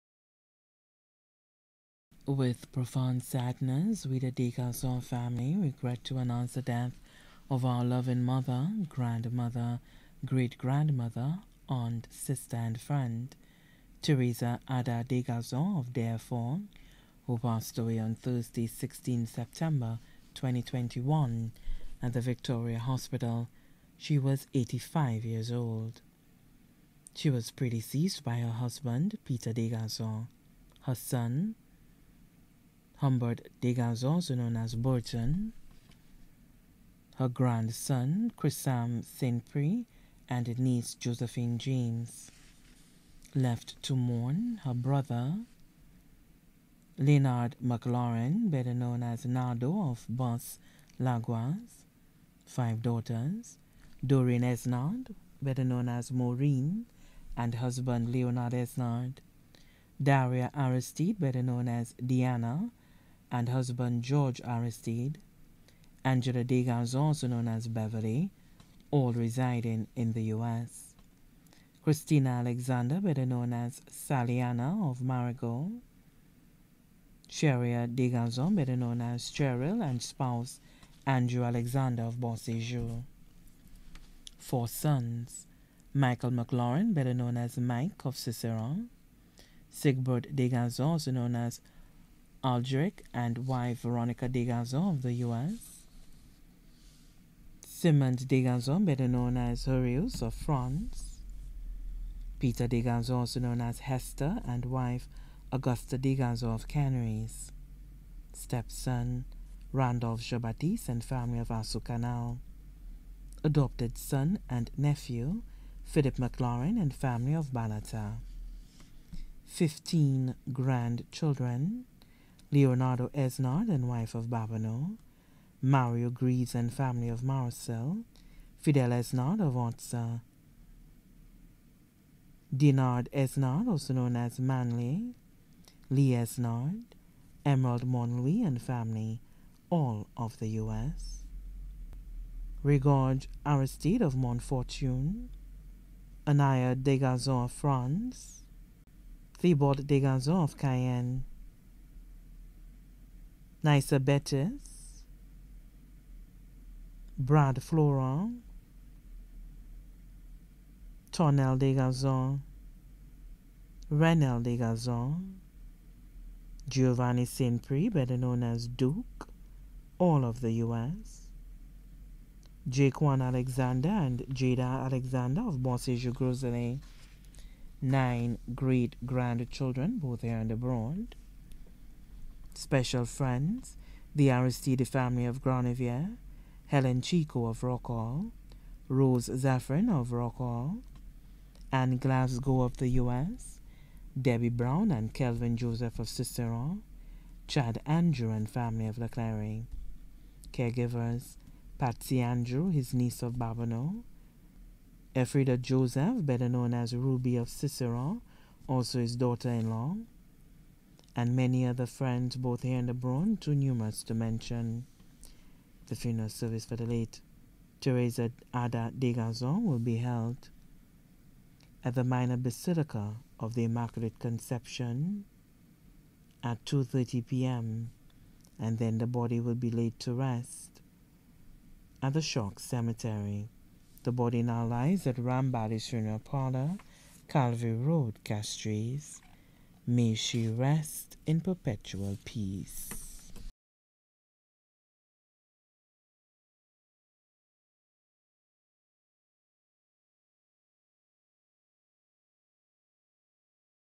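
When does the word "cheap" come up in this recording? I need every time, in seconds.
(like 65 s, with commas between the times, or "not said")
not said.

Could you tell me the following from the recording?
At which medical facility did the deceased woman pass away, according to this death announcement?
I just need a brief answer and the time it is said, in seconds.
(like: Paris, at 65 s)
Victoria Hospital, at 22 s.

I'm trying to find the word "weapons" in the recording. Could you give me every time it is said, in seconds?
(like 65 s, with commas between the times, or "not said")
not said.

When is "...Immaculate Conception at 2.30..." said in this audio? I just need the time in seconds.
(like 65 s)
223 s.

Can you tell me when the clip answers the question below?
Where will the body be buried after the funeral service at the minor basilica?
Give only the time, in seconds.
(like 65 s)
232 s.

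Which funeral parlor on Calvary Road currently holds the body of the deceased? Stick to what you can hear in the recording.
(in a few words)
Rambali Funeral Parlor.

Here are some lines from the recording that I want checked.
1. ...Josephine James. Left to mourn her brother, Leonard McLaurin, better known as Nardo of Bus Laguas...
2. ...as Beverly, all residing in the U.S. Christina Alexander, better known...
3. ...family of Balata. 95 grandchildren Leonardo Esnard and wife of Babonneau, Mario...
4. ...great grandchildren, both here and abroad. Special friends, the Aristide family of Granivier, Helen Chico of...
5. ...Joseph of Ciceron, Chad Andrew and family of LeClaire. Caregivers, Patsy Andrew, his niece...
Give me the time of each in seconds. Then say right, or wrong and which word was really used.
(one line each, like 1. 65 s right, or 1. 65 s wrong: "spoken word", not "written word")
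1. 40 s right
2. 67 s right
3. 116 s wrong: "15", not "95"
4. 178 s right
5. 195 s right.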